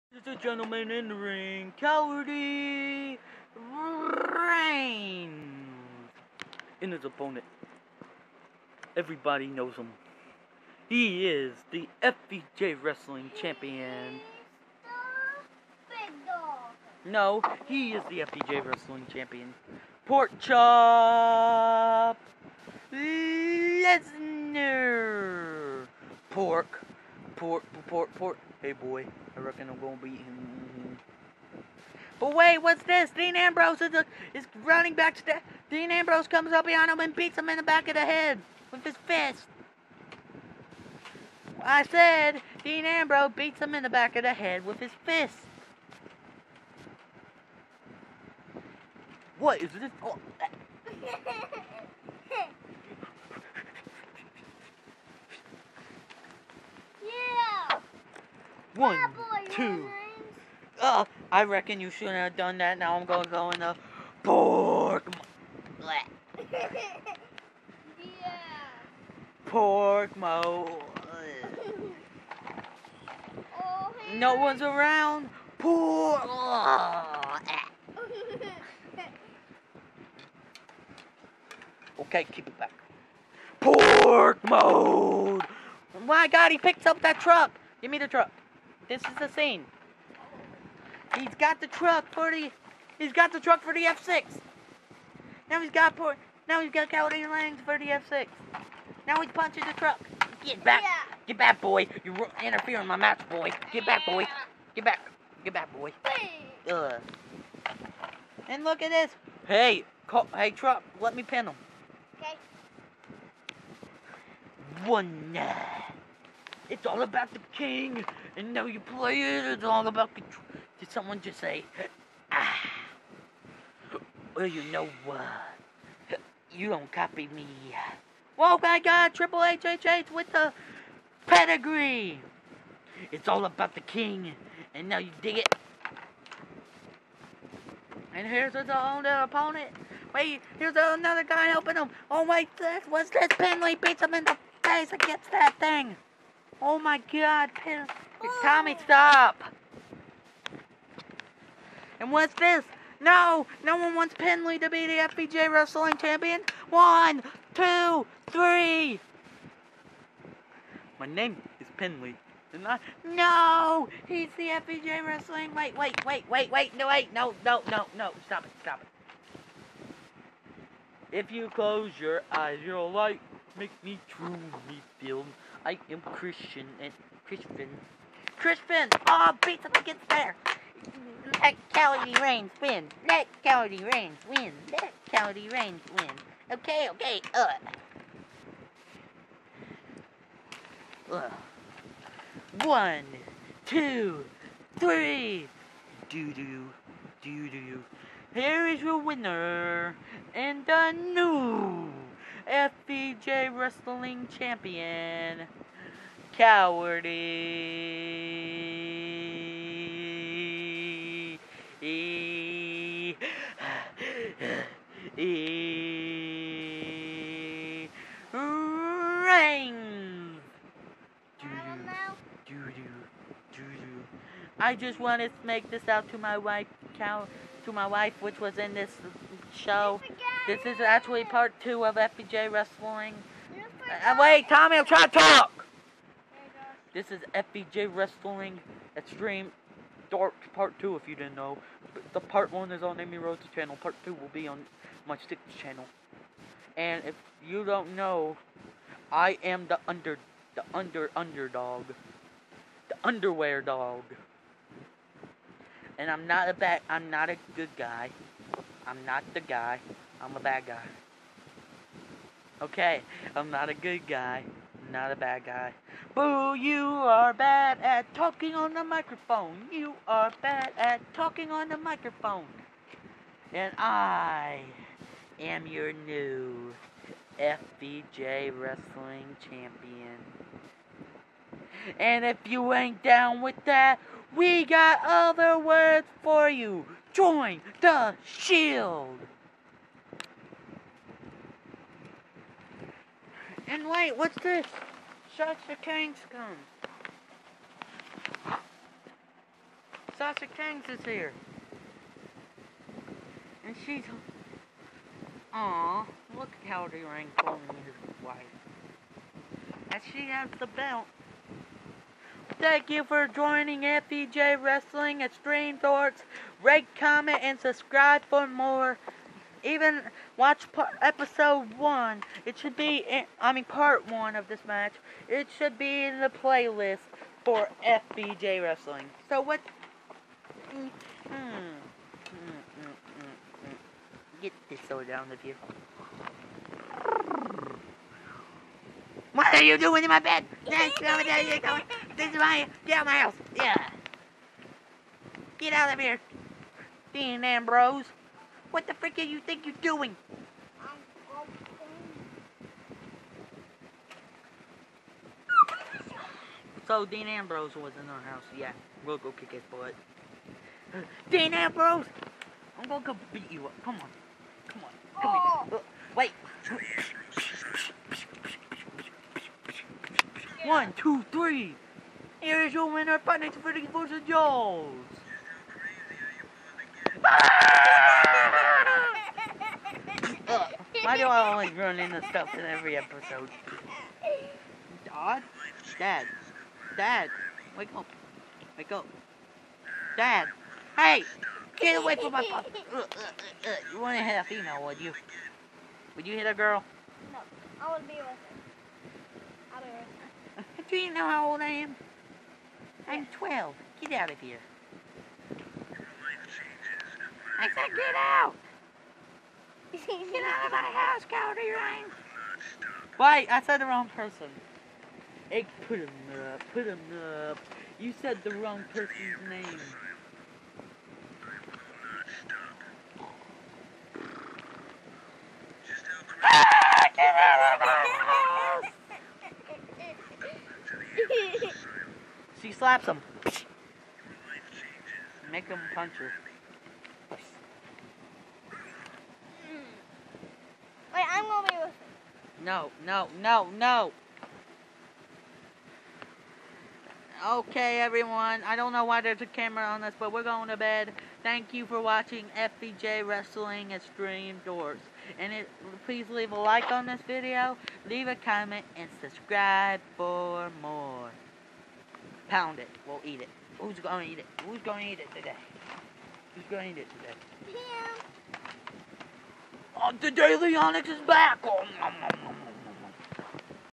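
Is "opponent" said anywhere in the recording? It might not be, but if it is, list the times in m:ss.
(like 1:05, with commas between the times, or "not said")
0:07, 2:19.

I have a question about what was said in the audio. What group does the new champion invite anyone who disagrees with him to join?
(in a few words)
The Shield.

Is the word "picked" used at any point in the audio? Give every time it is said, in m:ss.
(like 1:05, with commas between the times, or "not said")
1:26.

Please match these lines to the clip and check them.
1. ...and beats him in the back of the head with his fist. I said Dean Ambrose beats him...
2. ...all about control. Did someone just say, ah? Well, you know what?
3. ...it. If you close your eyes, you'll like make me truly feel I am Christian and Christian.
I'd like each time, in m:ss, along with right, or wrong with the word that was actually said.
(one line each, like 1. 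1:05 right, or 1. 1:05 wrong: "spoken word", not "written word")
1. 0:36 right
2. 1:59 right
3. 2:48 right.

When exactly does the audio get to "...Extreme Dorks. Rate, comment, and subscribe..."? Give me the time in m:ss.
5:15.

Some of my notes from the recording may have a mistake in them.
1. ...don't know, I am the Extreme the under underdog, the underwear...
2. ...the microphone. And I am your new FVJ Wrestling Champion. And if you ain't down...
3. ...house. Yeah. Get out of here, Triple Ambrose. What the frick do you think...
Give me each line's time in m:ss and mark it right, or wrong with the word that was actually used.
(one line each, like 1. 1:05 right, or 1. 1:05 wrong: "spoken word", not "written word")
1. 4:07 wrong: "Underdog", not "Extreme"
2. 4:31 right
3. 5:43 wrong: "Dean", not "Triple".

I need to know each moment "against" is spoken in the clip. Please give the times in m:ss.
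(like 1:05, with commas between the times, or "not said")
2:24, 2:59.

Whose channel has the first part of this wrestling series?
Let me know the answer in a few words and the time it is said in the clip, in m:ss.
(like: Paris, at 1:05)
Amy Rose, at 4:02.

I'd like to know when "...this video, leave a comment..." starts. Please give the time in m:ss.
7:37.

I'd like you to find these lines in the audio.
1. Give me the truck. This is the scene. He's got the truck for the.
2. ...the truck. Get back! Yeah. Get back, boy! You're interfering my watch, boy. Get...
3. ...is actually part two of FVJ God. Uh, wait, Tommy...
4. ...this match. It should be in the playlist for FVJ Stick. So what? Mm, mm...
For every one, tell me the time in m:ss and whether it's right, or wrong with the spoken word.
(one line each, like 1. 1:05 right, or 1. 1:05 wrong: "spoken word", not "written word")
1. 1:27 right
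2. 1:39 wrong: "match", not "watch"
3. 3:50 wrong: "Wrestling", not "God"
4. 5:24 wrong: "Wrestling", not "Stick".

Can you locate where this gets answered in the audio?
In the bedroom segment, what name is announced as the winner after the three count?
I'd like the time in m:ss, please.
6:13.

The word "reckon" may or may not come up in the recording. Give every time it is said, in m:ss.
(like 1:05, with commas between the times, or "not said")
0:29, 1:01.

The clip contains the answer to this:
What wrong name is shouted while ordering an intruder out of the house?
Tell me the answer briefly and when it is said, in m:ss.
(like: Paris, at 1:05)
Calderine, at 6:51.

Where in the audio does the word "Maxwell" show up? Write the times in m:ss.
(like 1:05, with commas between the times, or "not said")
not said.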